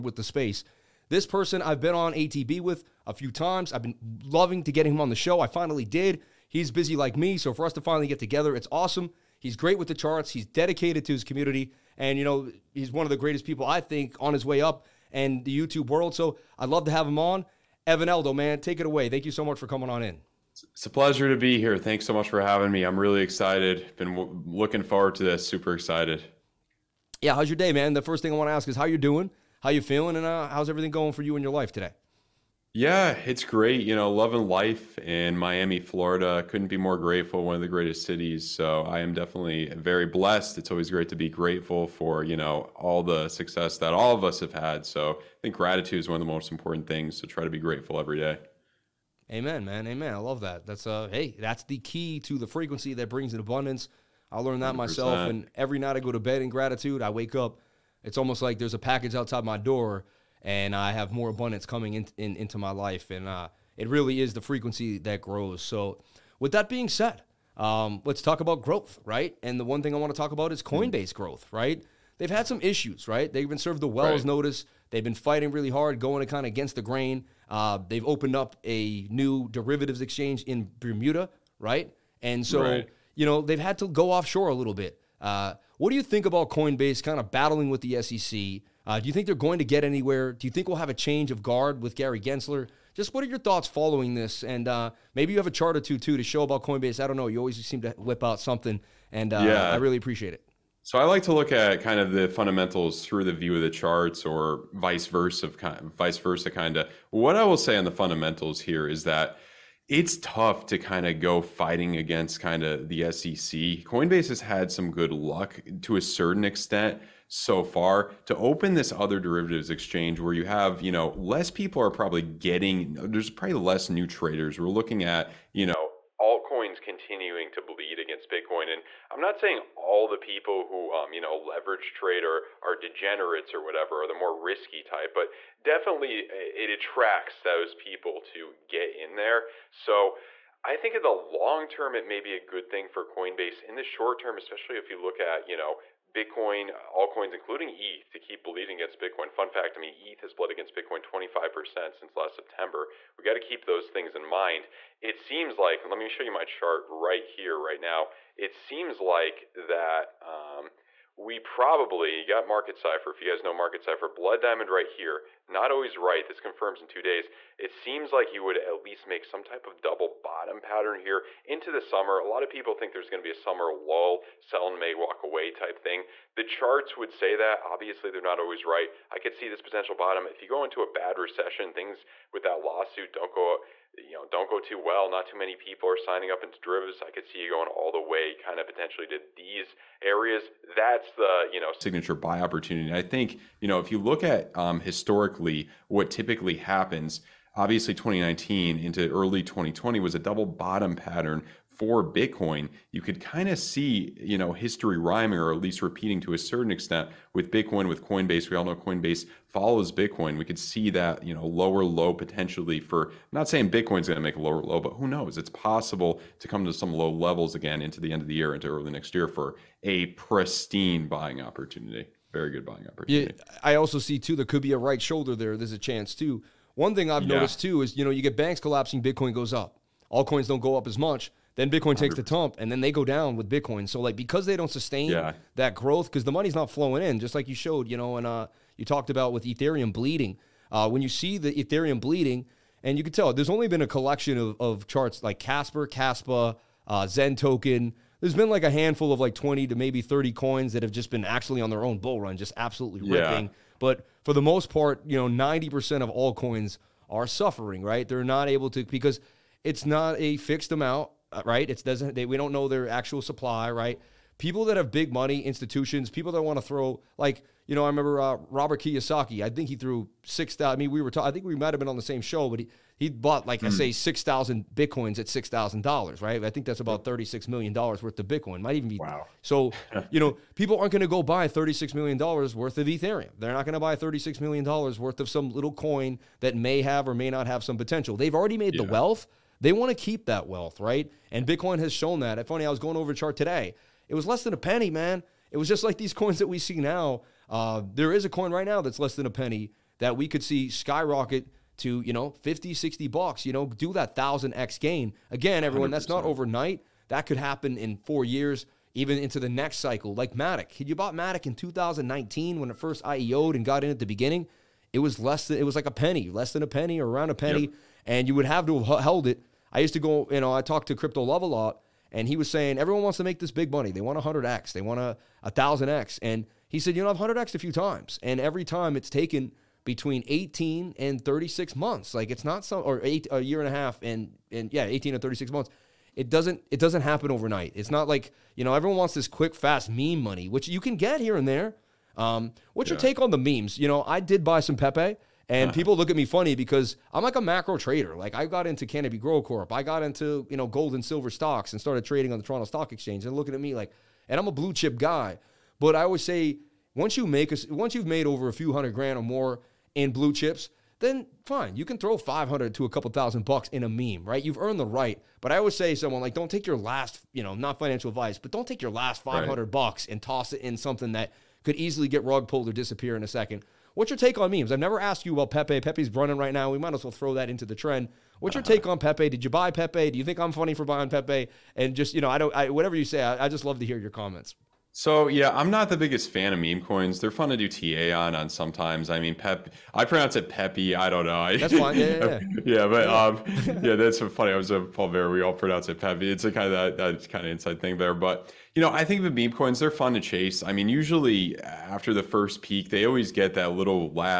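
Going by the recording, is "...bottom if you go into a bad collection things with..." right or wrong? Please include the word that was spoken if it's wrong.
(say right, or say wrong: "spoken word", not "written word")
wrong: "recession", not "collection".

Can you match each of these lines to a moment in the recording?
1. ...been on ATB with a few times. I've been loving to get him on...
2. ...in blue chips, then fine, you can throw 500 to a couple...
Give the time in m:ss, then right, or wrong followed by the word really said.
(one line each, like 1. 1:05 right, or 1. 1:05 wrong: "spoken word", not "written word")
1. 0:01 right
2. 5:59 right.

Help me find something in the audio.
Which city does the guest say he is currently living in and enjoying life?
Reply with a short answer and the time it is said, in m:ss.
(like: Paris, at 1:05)
Miami, Florida, at 0:35.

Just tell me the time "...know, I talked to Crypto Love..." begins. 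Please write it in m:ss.
5:20.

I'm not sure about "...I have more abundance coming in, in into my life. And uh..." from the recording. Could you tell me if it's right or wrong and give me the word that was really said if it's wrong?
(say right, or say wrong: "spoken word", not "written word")
right.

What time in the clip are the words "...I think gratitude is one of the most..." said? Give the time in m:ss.
0:45.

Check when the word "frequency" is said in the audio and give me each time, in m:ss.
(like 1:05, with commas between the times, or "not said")
0:52, 1:04.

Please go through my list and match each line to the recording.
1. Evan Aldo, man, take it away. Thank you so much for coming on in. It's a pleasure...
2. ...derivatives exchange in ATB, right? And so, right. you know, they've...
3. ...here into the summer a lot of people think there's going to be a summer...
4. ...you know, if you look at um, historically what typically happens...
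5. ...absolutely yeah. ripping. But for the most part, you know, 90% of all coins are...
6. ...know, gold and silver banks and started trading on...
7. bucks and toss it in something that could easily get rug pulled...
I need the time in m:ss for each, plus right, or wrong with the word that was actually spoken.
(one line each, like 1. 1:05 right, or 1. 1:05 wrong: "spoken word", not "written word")
1. 0:17 right
2. 1:19 wrong: "Bermuda", not "ATB"
3. 2:50 right
4. 3:13 right
5. 4:12 right
6. 5:50 wrong: "stocks", not "banks"
7. 6:09 right.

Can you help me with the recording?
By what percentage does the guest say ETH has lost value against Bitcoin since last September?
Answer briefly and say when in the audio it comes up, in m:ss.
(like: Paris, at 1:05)
25%, at 2:31.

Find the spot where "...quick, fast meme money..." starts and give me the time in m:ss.
5:39.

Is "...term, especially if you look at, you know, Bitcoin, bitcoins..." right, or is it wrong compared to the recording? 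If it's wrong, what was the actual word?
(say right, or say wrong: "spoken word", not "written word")
wrong: "altcoins", not "bitcoins".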